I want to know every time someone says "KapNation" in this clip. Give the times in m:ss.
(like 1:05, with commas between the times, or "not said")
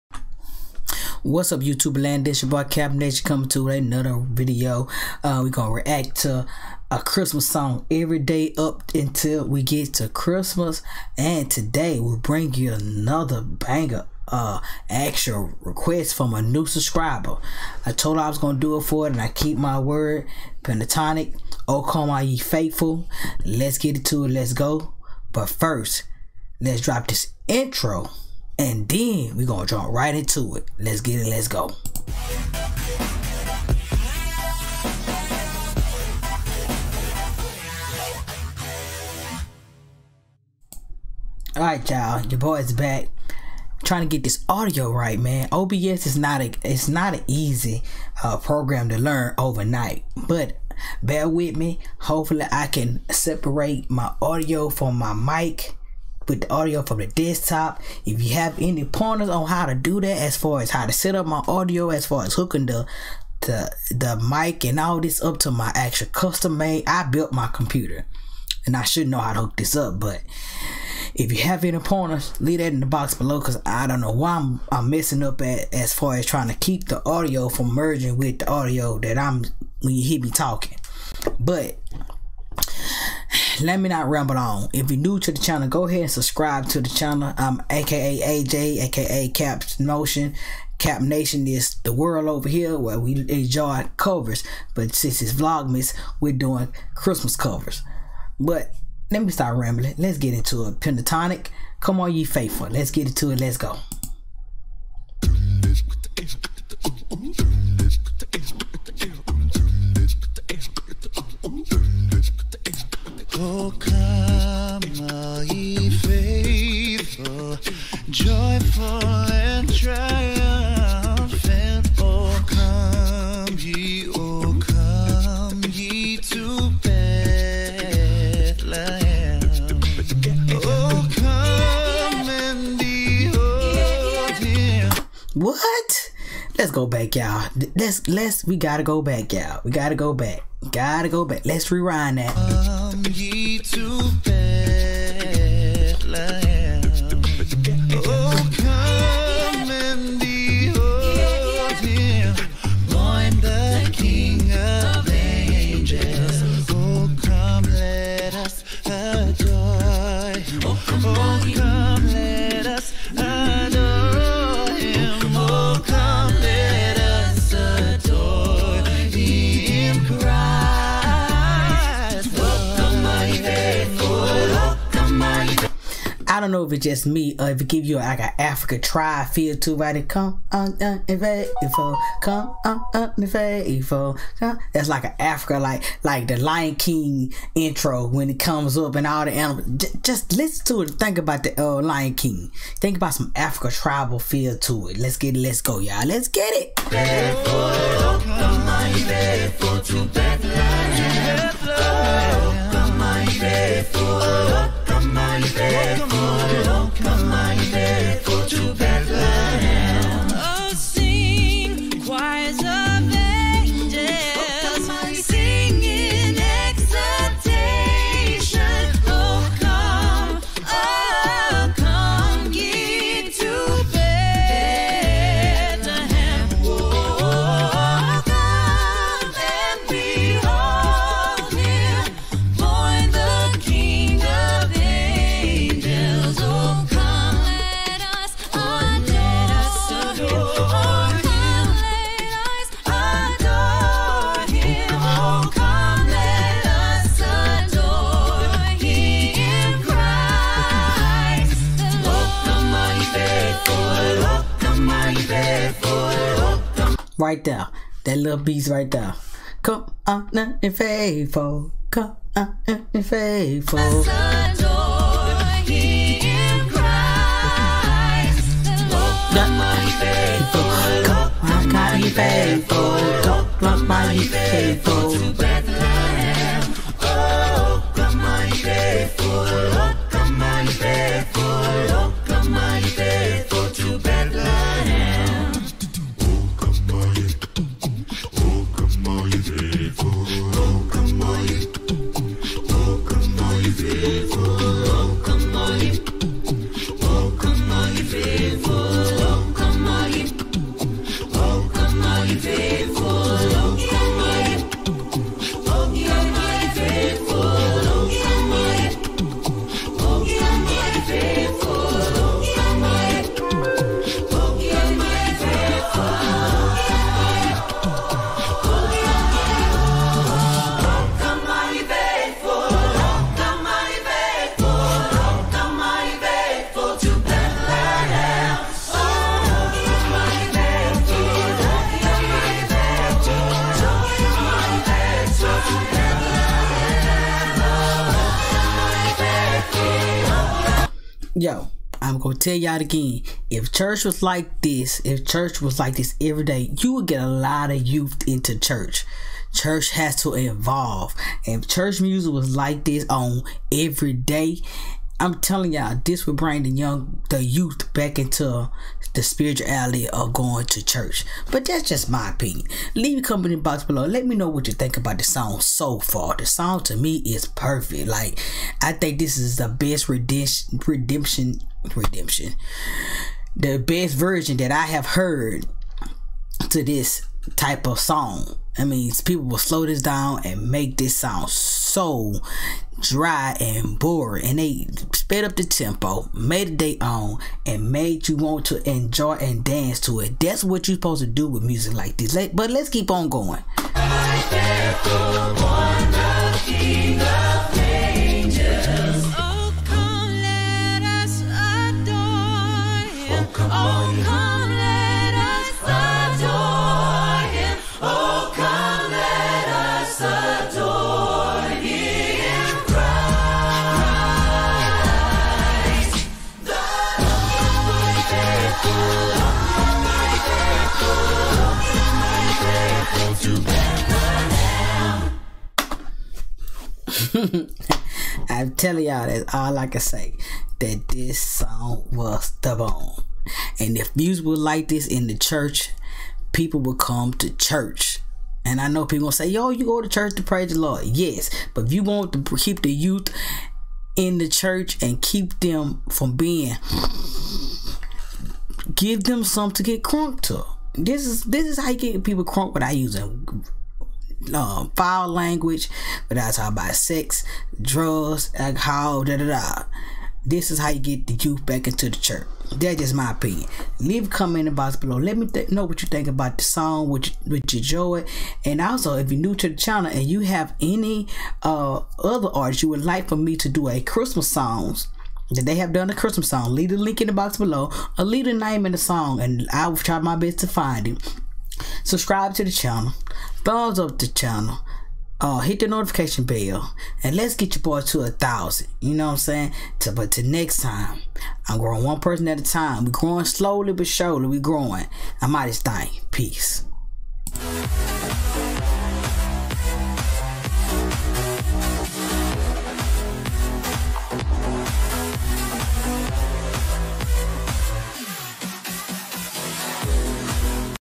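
0:02, 1:30.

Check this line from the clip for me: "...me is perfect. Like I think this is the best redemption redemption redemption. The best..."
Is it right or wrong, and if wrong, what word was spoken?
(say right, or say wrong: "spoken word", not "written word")
right.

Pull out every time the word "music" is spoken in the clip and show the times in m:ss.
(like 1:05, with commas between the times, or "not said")
5:51, 6:31, 7:14.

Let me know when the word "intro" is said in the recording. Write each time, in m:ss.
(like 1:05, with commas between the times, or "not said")
0:27, 3:07.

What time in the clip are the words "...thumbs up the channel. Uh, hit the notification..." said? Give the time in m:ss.
8:03.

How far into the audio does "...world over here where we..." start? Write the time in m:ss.
1:31.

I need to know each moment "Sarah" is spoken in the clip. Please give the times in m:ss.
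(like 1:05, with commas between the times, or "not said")
not said.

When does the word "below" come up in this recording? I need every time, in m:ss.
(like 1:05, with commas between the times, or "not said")
1:13, 6:03, 7:44, 7:57.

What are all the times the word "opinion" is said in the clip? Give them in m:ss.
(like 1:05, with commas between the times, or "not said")
6:02, 7:43.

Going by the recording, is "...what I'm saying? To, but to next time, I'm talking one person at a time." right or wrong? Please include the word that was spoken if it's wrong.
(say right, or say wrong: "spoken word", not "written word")
wrong: "growing", not "talking".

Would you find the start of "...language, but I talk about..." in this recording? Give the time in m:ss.
7:35.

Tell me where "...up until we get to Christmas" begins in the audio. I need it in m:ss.
0:08.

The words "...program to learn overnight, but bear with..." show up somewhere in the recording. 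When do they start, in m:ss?
0:48.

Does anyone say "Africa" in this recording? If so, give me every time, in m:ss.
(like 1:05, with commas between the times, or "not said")
2:58, 3:05, 3:13.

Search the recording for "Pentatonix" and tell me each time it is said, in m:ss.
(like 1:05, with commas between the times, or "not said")
0:20, 1:40.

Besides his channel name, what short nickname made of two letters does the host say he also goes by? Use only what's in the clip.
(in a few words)
AJ.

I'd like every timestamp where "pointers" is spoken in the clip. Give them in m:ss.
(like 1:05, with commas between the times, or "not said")
0:58, 1:11.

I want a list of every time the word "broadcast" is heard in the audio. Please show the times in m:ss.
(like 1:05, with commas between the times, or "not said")
not said.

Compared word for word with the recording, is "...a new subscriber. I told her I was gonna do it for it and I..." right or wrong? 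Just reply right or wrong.
right.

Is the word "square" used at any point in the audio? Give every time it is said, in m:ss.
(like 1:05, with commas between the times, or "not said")
not said.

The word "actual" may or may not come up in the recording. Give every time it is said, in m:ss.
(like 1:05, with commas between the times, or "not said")
0:14, 1:05.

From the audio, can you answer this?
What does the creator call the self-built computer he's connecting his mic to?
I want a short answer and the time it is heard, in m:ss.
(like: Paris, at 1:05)
custom made, at 1:06.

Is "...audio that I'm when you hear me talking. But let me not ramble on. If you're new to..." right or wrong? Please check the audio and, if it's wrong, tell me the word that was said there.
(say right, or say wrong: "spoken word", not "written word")
right.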